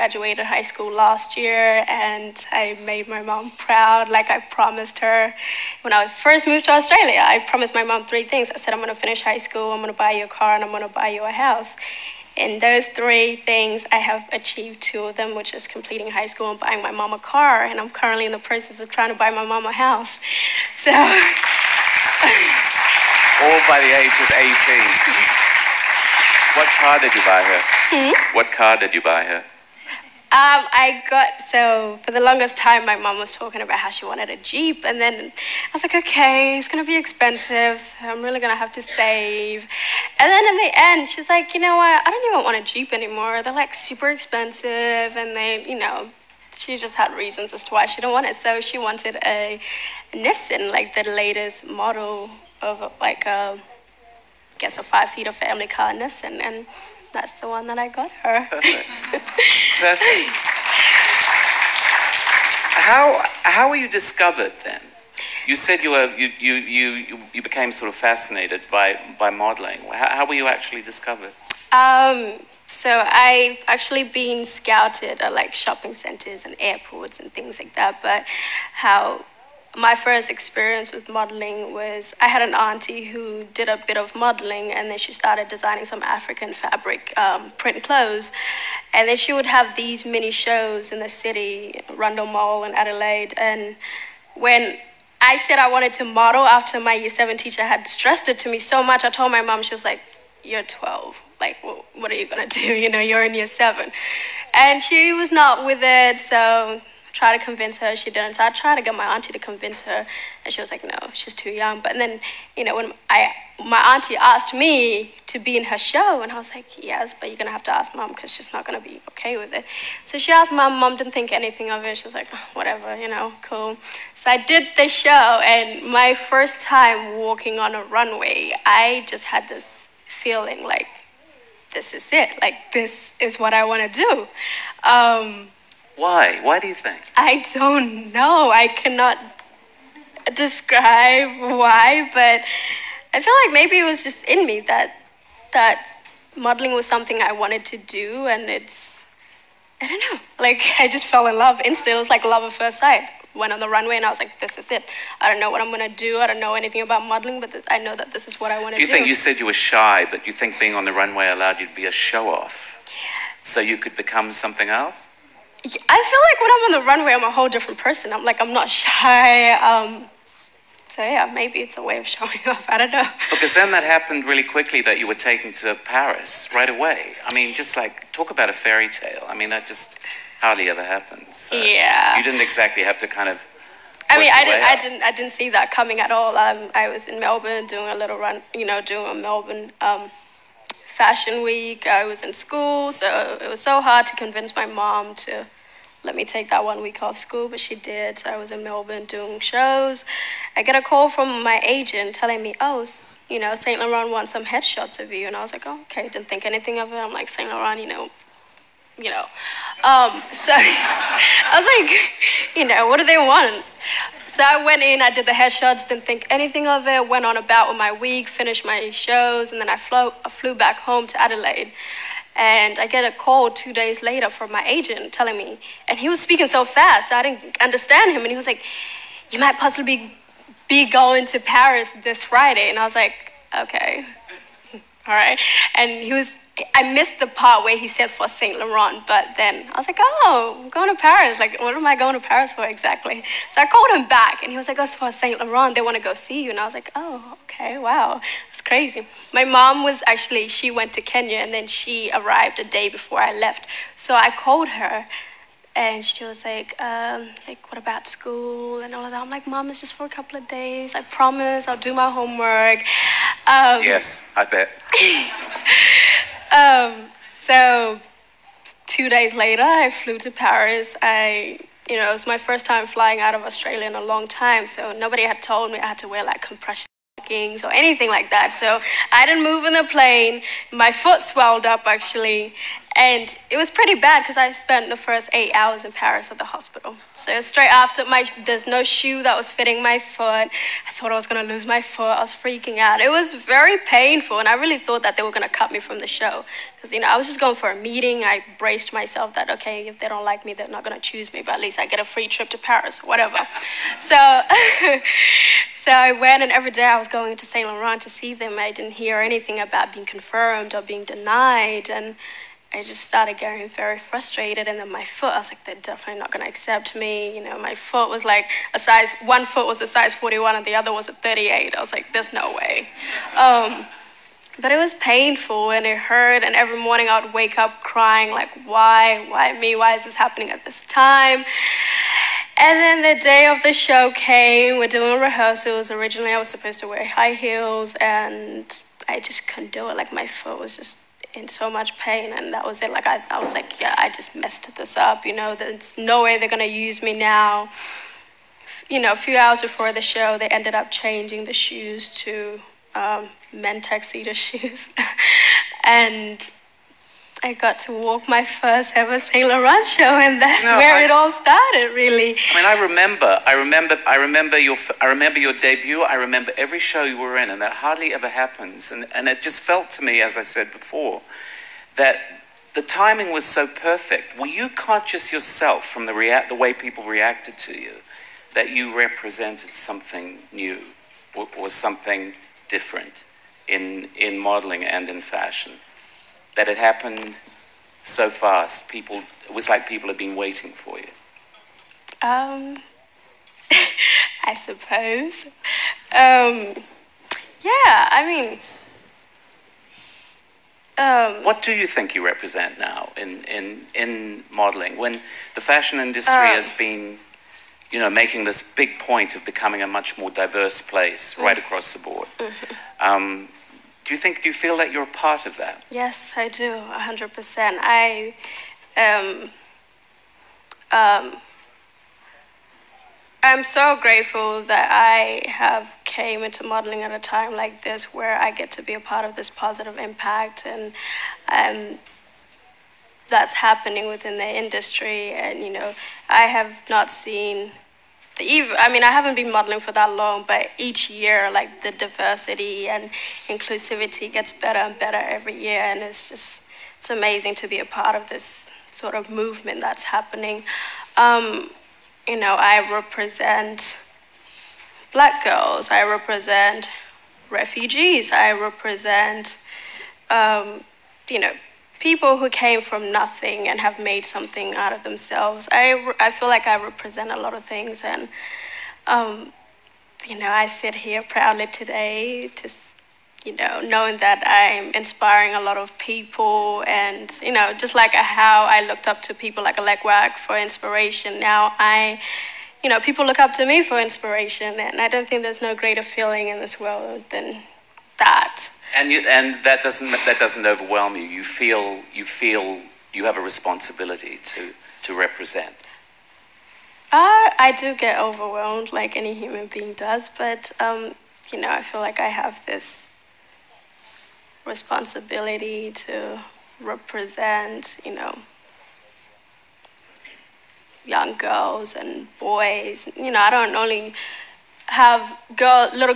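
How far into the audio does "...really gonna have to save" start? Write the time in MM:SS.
00:38.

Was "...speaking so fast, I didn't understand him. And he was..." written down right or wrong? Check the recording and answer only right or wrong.
right.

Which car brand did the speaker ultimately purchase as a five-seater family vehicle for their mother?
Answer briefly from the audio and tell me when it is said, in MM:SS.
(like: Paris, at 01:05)
Nissan, at 00:50.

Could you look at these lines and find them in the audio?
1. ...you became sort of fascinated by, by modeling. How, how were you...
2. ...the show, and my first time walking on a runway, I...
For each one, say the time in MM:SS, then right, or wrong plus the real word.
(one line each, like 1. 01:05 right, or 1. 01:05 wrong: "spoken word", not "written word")
1. 01:07 right
2. 02:04 right.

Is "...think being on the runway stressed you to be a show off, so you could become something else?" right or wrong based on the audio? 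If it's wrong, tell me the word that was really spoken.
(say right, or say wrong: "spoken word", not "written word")
wrong: "allowed", not "stressed".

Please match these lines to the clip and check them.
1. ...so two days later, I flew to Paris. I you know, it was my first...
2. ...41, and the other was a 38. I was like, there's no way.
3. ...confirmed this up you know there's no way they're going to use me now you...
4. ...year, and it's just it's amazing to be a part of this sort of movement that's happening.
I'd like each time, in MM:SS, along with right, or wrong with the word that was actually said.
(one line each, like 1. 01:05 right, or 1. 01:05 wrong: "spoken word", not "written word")
1. 04:27 right
2. 05:20 right
3. 05:44 wrong: "messed", not "confirmed"
4. 07:25 right.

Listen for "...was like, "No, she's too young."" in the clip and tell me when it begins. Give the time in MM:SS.
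01:50.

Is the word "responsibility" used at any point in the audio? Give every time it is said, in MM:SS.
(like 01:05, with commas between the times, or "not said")
08:13, 08:24.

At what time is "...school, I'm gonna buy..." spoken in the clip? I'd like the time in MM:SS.
00:09.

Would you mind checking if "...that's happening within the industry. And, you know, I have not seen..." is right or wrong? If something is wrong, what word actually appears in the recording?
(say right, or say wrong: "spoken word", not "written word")
right.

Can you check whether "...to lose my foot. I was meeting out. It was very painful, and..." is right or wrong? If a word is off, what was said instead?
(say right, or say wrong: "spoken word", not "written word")
wrong: "freaking", not "meeting".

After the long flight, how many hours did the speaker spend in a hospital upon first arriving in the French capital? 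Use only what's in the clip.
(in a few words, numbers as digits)
8.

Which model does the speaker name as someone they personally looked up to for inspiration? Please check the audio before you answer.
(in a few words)
Alek Wek.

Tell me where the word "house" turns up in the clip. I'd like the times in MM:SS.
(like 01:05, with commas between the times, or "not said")
00:11, 00:19.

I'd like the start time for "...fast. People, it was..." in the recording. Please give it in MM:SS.
06:28.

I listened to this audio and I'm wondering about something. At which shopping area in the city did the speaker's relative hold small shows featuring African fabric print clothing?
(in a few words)
Rundle Mall.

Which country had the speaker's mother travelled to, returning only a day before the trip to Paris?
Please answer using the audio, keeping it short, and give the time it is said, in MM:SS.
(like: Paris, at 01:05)
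Kenya, at 04:11.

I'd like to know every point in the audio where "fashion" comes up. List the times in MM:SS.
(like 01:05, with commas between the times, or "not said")
03:10, 06:25, 06:45.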